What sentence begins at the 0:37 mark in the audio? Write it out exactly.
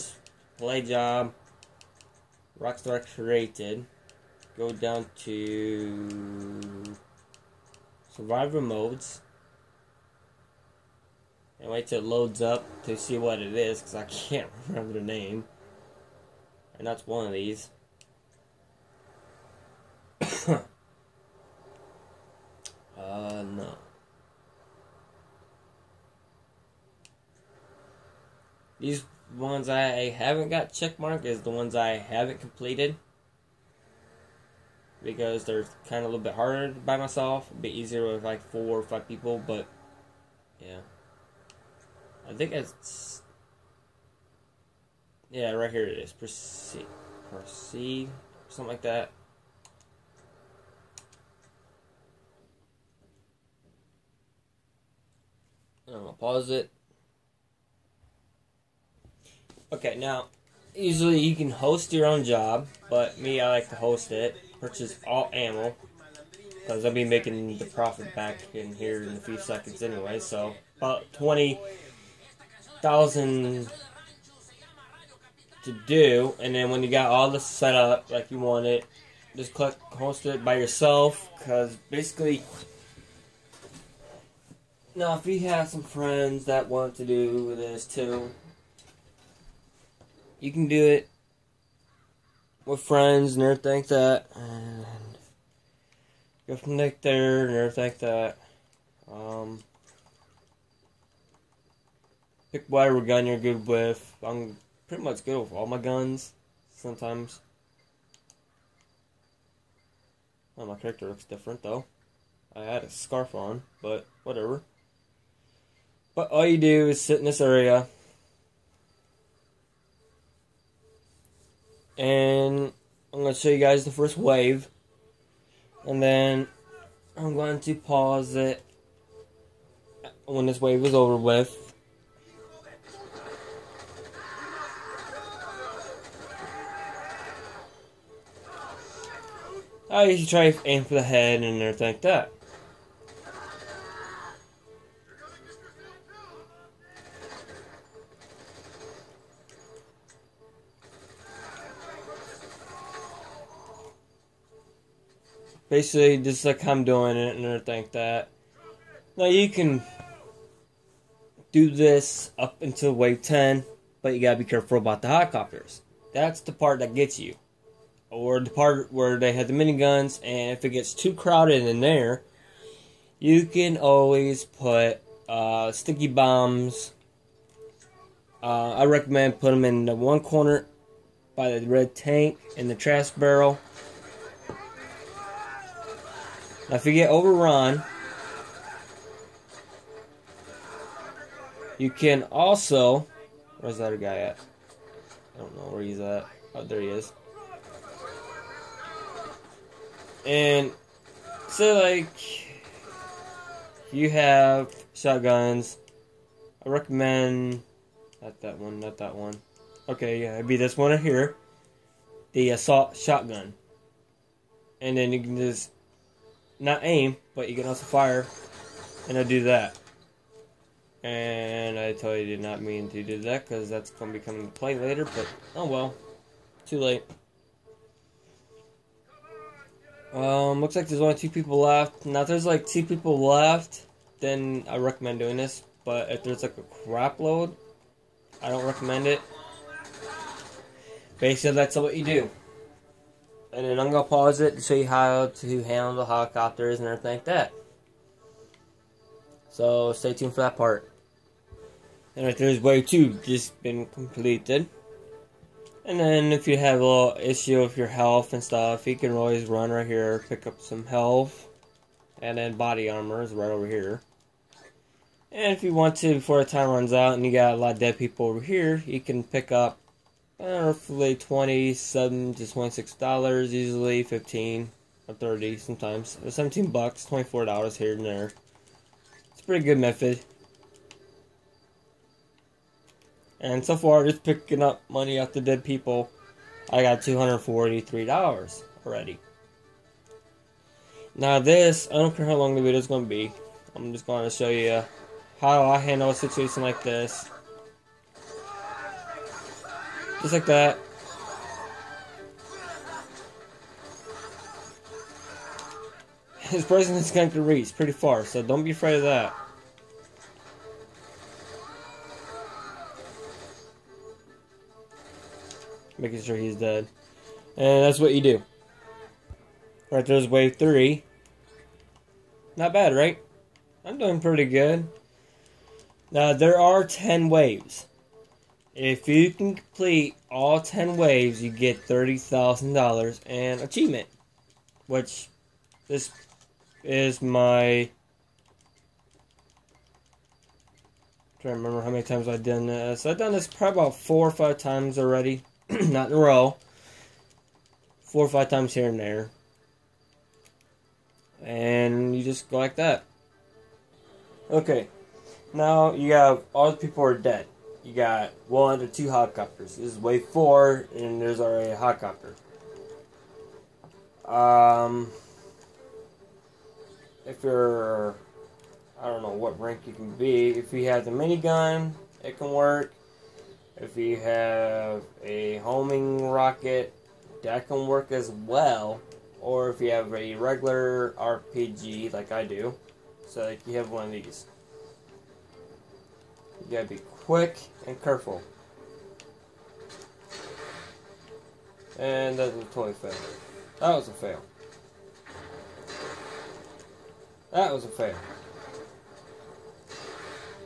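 A bit easier with like four or five people, but yeah.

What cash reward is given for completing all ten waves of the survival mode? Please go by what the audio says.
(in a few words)
$30,000.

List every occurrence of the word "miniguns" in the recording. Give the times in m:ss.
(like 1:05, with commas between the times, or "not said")
2:49, 6:11.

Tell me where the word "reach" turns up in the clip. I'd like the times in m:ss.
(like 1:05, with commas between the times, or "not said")
5:07.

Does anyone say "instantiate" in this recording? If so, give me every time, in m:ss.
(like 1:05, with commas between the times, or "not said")
not said.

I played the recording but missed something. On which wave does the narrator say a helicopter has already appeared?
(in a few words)
Wave 4.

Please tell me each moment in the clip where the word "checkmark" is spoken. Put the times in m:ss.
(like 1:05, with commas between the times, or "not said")
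0:30.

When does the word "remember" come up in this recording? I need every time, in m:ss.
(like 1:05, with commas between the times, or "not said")
0:14, 5:41.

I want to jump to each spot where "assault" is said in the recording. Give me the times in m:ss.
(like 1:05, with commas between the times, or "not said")
3:32.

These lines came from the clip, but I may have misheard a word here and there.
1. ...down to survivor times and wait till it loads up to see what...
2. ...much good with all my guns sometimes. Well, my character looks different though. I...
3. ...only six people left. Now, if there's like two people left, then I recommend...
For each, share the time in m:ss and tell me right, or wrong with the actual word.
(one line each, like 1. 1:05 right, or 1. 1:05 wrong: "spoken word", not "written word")
1. 0:04 wrong: "modes", not "times"
2. 1:45 right
3. 3:51 wrong: "two", not "six".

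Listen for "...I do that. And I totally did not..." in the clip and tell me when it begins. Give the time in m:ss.
3:39.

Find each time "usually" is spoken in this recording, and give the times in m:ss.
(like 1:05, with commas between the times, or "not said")
1:00, 2:20, 4:33.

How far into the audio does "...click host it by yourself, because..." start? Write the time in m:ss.
1:19.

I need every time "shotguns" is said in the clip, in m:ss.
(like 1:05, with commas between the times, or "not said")
3:24, 3:32.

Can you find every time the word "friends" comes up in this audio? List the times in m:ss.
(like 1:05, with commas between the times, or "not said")
1:25, 1:32.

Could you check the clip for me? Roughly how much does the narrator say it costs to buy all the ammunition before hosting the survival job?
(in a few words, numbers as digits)
20,000.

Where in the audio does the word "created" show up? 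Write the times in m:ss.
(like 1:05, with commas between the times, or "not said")
0:03.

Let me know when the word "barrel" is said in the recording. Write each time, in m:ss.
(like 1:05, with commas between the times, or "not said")
3:03.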